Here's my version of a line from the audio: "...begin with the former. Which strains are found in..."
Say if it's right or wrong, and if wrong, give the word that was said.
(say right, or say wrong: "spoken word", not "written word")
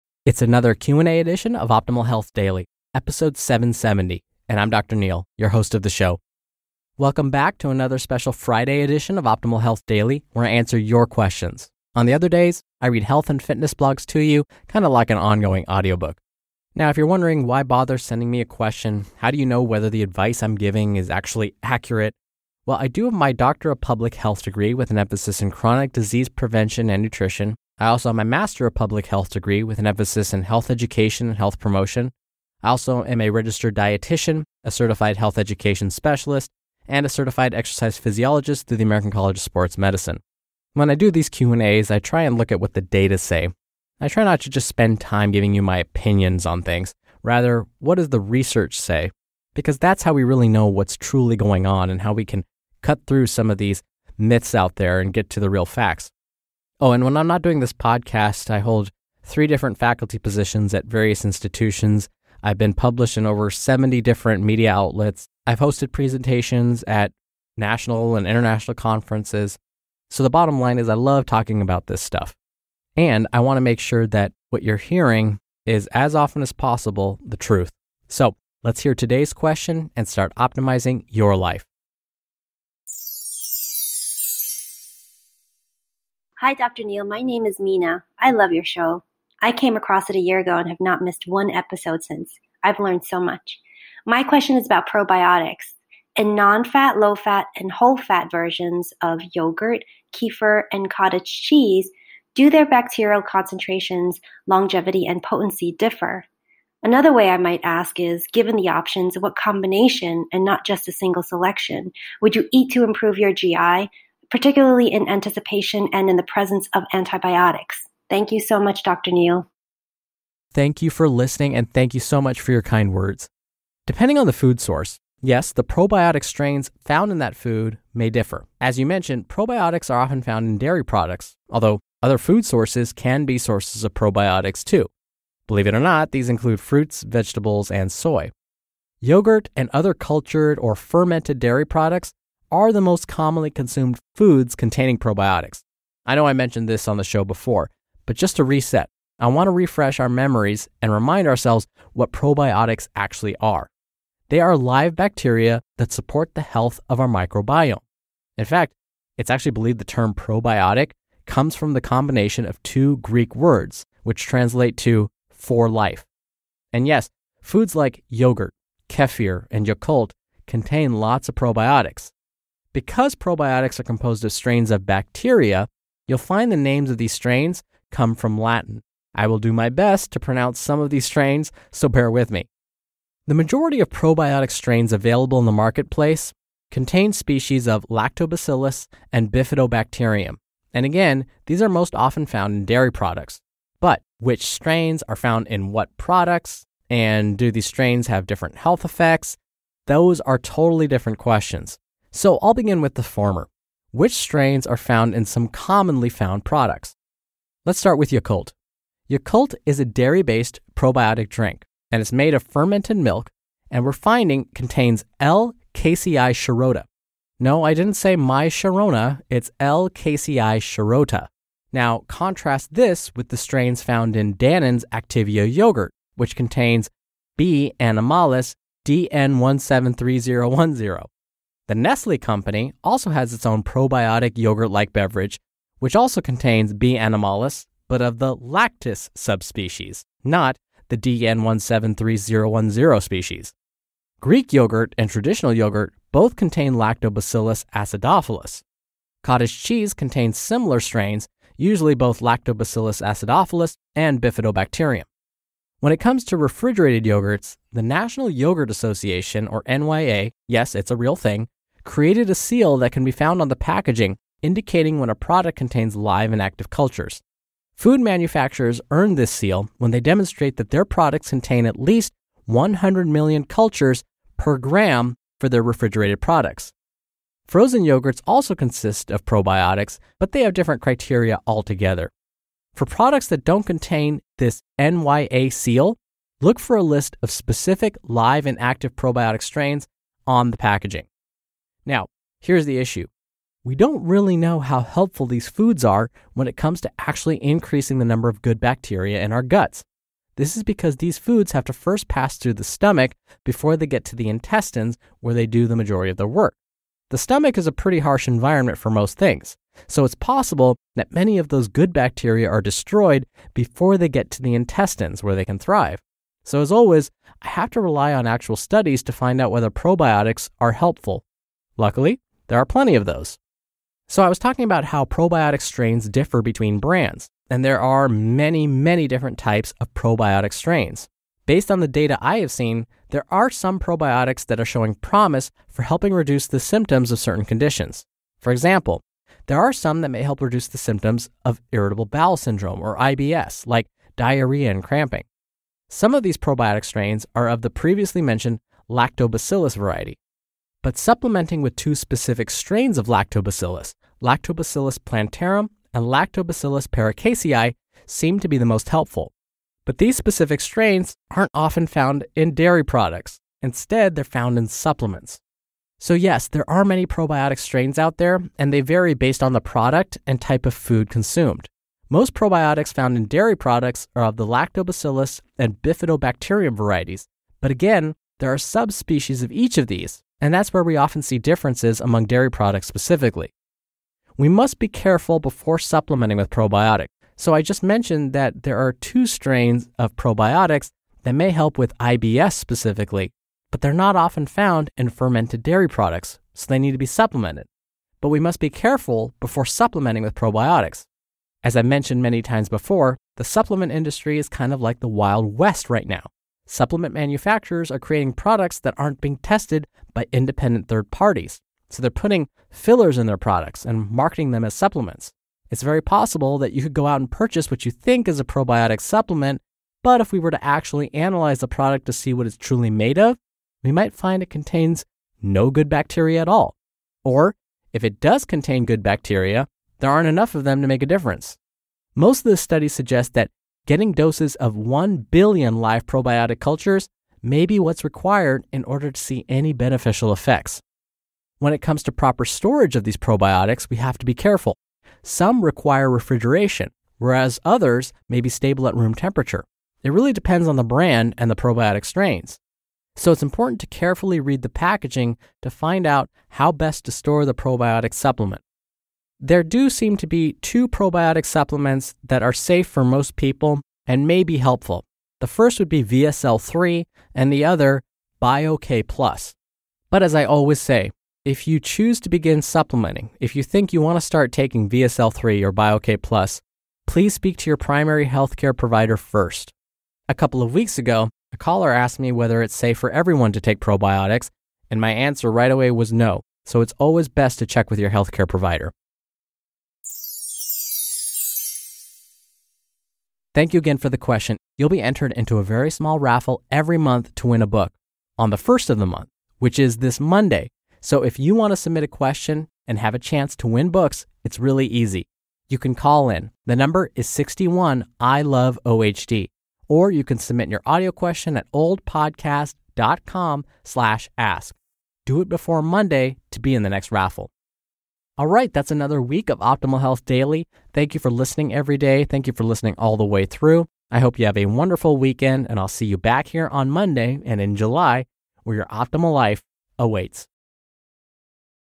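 right.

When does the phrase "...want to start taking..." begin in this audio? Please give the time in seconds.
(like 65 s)
473 s.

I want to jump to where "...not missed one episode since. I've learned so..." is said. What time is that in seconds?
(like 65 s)
90 s.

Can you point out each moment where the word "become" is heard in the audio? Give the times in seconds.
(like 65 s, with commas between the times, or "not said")
not said.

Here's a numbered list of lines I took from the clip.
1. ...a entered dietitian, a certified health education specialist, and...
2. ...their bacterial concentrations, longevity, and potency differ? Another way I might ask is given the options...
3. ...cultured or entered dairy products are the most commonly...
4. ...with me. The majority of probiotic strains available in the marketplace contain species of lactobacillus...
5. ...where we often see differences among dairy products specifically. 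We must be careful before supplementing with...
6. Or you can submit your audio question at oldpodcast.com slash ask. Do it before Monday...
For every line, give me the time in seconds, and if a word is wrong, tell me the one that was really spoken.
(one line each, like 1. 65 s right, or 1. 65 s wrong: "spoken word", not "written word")
1. 33 s wrong: "registered", not "entered"
2. 102 s right
3. 139 s wrong: "fermented", not "entered"
4. 182 s right
5. 380 s right
6. 509 s right.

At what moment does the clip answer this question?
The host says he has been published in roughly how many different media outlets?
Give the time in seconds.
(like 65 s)
63 s.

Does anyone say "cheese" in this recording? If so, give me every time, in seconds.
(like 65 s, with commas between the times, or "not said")
101 s, 249 s.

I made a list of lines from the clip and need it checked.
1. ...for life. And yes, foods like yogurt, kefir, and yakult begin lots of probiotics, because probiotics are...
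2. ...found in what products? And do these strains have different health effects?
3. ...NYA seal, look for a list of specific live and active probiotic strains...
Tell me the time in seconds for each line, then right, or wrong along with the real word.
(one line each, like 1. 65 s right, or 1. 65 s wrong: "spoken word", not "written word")
1. 165 s wrong: "contain", not "begin"
2. 195 s right
3. 284 s right.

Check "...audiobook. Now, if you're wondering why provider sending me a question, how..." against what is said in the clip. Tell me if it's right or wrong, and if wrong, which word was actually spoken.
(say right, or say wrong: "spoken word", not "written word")
wrong: "bother", not "provider".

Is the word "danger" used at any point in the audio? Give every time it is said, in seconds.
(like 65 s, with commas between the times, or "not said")
not said.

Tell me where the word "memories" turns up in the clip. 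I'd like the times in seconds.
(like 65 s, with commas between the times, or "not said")
150 s.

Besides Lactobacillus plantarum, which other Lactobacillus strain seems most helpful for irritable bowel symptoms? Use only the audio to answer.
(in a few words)
Lactobacillus paracasei.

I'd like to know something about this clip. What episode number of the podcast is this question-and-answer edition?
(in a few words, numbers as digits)
770.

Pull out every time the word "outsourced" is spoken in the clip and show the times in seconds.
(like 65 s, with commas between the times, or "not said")
not said.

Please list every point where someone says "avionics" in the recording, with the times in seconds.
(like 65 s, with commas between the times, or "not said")
not said.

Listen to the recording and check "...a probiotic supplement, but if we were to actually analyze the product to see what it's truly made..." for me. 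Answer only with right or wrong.
right.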